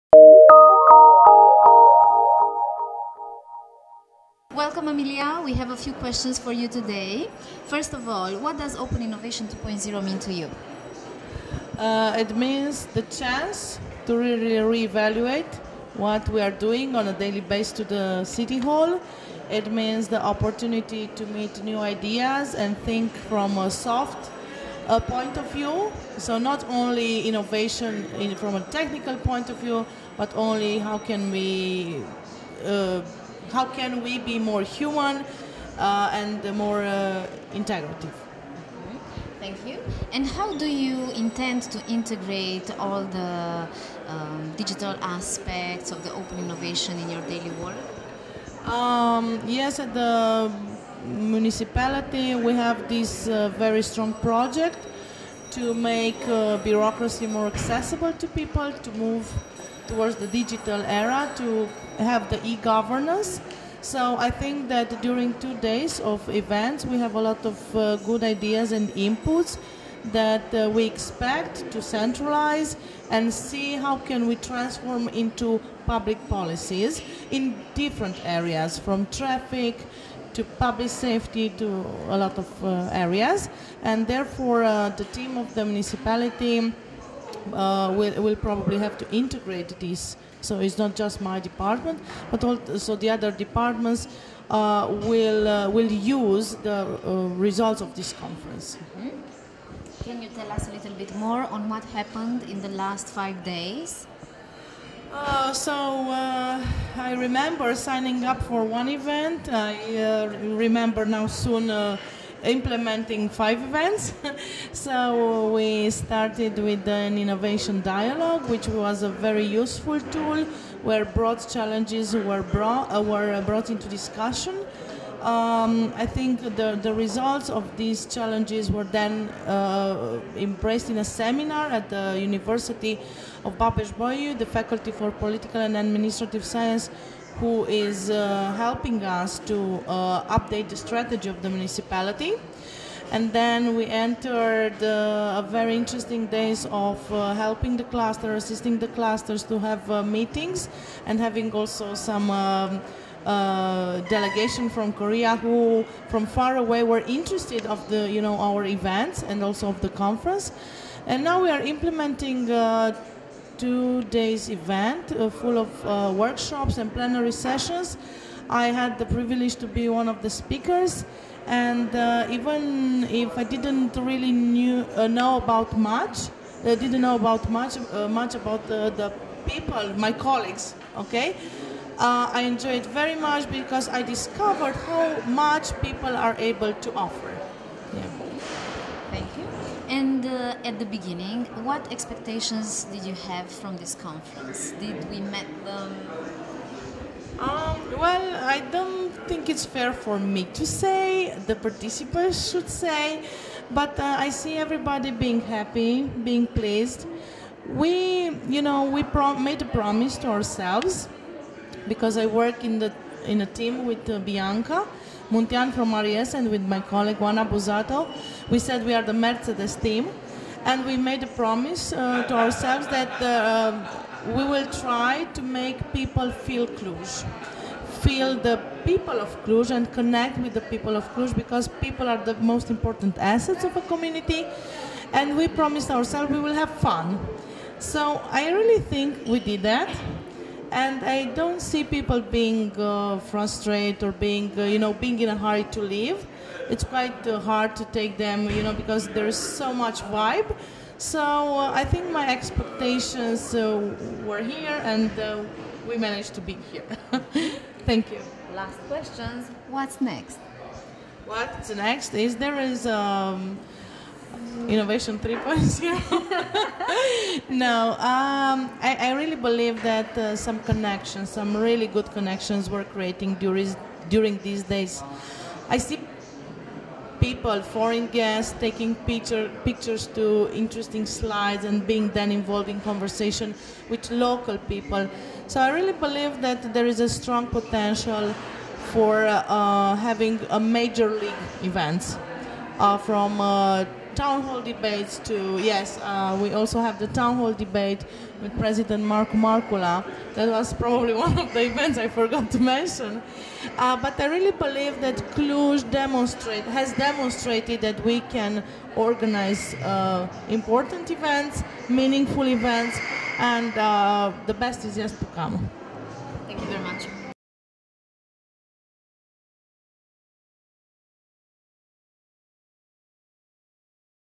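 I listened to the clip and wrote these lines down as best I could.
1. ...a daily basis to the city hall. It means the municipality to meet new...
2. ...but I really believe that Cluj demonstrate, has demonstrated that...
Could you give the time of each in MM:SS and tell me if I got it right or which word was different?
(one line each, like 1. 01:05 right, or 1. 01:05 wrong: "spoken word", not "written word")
1. 00:17 wrong: "opportunity", not "municipality"
2. 05:03 right.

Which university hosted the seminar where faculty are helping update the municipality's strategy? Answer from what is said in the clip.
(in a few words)
Babes Bolyai.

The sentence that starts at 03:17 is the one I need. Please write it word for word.
Um, well, I don't think it's fair for me to say.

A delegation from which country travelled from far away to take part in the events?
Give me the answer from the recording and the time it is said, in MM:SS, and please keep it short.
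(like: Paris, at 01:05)
Korea, at 02:34.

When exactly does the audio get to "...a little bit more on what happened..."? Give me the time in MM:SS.
01:40.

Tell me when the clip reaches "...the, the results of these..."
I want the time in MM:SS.
02:06.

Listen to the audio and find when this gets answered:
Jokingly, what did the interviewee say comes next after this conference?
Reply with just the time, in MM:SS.
04:24.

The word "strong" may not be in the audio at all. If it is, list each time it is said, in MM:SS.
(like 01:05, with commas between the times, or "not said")
00:53, 04:47.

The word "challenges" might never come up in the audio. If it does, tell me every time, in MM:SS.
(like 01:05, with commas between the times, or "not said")
02:01, 02:08.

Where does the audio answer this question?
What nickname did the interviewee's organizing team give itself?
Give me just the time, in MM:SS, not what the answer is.
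03:39.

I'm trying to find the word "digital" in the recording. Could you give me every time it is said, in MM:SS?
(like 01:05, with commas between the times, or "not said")
00:44, 01:00.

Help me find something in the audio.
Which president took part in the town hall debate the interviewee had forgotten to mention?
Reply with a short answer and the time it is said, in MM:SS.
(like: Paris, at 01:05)
Markku Markkula, at 04:59.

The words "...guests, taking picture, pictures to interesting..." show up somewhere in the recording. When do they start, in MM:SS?
04:38.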